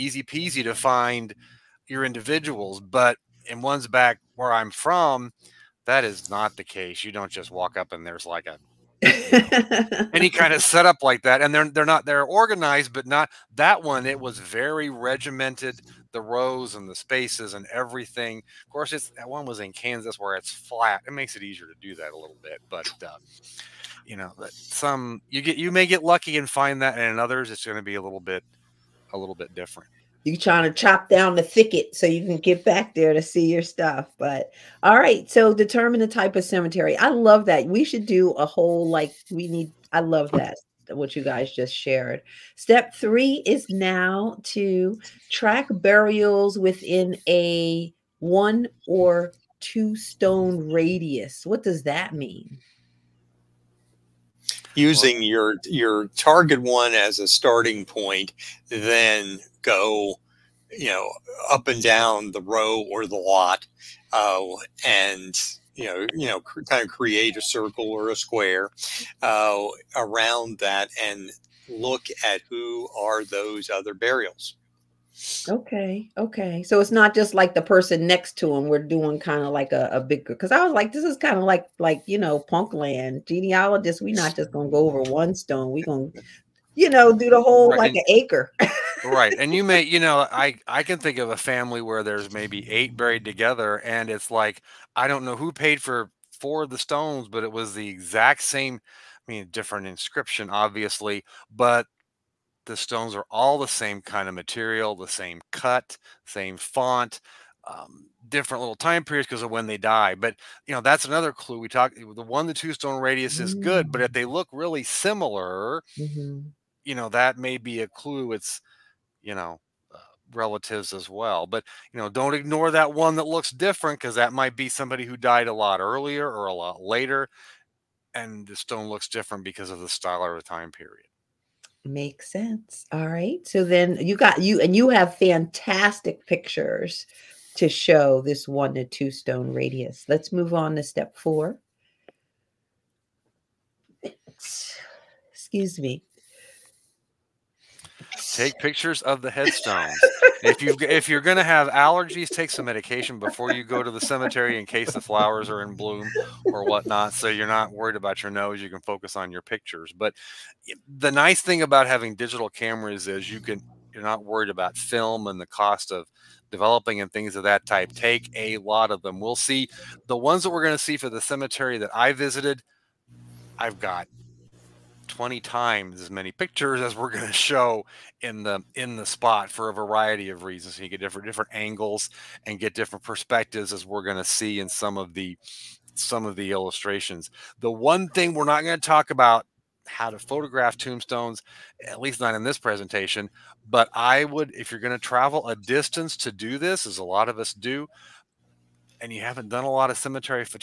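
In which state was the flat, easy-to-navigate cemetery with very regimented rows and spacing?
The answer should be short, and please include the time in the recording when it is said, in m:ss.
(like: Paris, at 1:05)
Kansas, at 0:19.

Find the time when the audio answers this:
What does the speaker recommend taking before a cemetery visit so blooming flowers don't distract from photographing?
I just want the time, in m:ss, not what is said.
2:32.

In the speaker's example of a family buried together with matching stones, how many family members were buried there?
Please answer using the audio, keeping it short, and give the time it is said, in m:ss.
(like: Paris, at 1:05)
8, at 1:32.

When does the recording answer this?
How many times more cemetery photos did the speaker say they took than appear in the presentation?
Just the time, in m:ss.
2:55.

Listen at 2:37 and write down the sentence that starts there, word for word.
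So you're not worried about your nose.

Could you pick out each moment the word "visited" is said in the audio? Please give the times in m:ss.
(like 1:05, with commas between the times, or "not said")
2:52.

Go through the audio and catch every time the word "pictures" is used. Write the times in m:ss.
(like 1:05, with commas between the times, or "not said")
2:16, 2:28, 2:39, 2:56.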